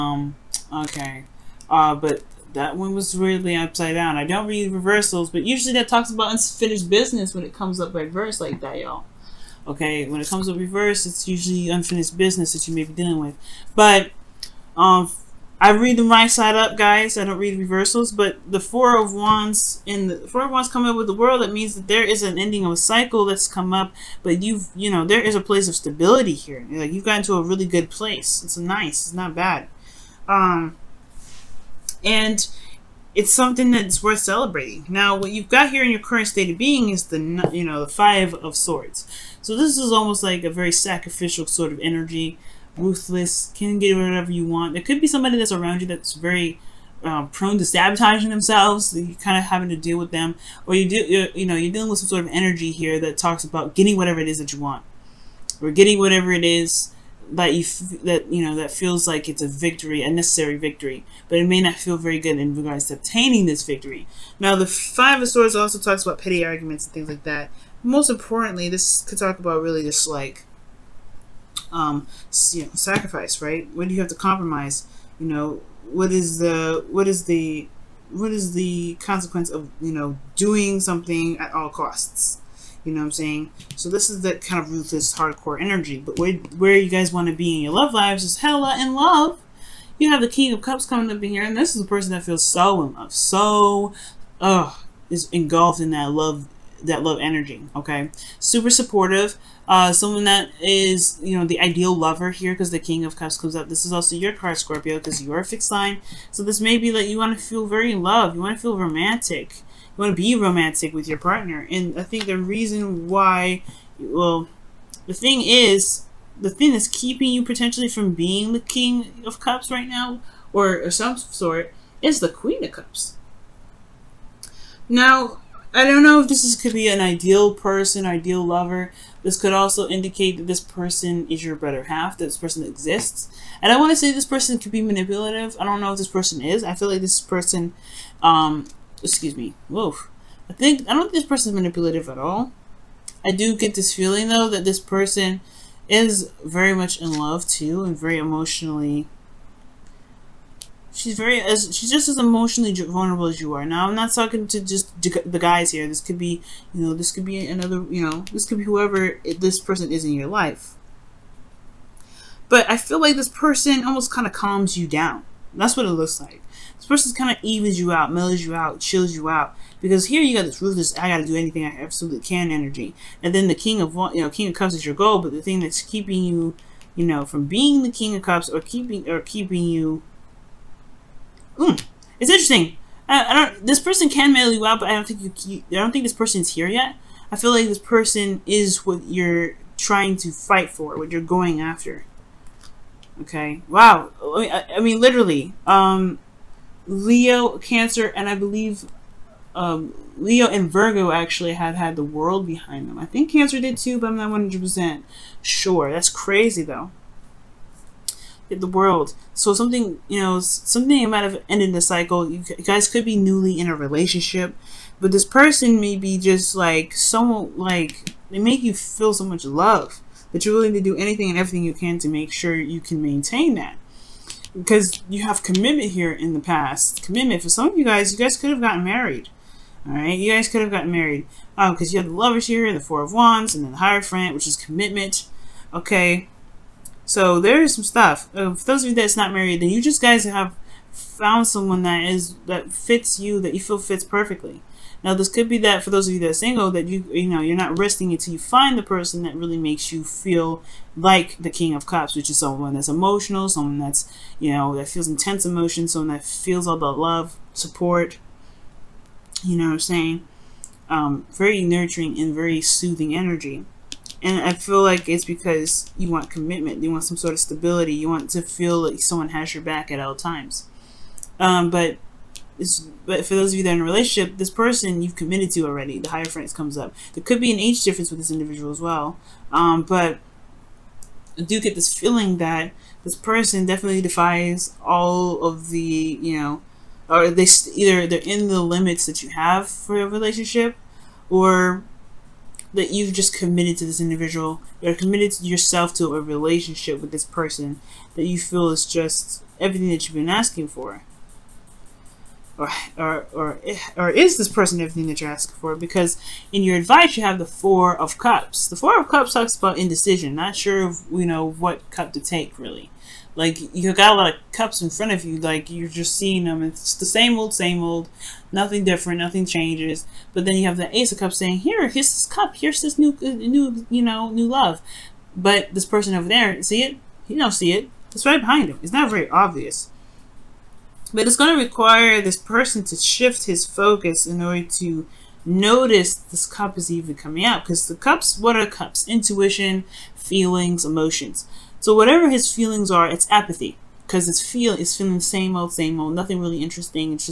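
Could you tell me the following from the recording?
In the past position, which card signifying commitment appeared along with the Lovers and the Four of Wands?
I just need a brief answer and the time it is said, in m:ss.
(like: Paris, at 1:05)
The Hierophant, at 3:53.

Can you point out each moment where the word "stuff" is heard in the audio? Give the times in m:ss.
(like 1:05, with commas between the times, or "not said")
3:57.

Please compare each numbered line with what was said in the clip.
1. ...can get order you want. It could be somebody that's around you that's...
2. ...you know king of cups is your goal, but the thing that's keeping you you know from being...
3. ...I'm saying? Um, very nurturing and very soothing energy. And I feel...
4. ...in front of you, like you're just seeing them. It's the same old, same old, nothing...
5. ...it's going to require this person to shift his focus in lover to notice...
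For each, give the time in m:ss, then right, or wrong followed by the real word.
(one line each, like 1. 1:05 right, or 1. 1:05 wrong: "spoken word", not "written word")
1. 0:43 wrong: "whatever", not "order"
2. 2:54 right
3. 4:19 right
4. 5:14 right
5. 5:31 wrong: "order", not "lover".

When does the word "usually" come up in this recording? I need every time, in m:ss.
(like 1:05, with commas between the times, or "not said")
0:05, 0:11.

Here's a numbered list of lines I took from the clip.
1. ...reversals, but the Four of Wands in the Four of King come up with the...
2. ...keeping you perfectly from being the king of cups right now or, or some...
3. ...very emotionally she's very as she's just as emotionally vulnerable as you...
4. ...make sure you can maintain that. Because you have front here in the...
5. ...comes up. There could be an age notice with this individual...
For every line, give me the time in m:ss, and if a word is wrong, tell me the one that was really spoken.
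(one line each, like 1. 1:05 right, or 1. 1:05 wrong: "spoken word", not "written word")
1. 0:17 wrong: "Wands", not "King"
2. 1:56 wrong: "potentially", not "perfectly"
3. 2:27 right
4. 3:42 wrong: "commitment", not "front"
5. 4:36 wrong: "difference", not "notice".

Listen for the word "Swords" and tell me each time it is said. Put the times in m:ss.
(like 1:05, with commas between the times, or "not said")
0:38, 1:05.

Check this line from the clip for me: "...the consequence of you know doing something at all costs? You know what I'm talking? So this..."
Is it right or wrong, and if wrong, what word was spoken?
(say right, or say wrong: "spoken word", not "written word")
wrong: "saying", not "talking".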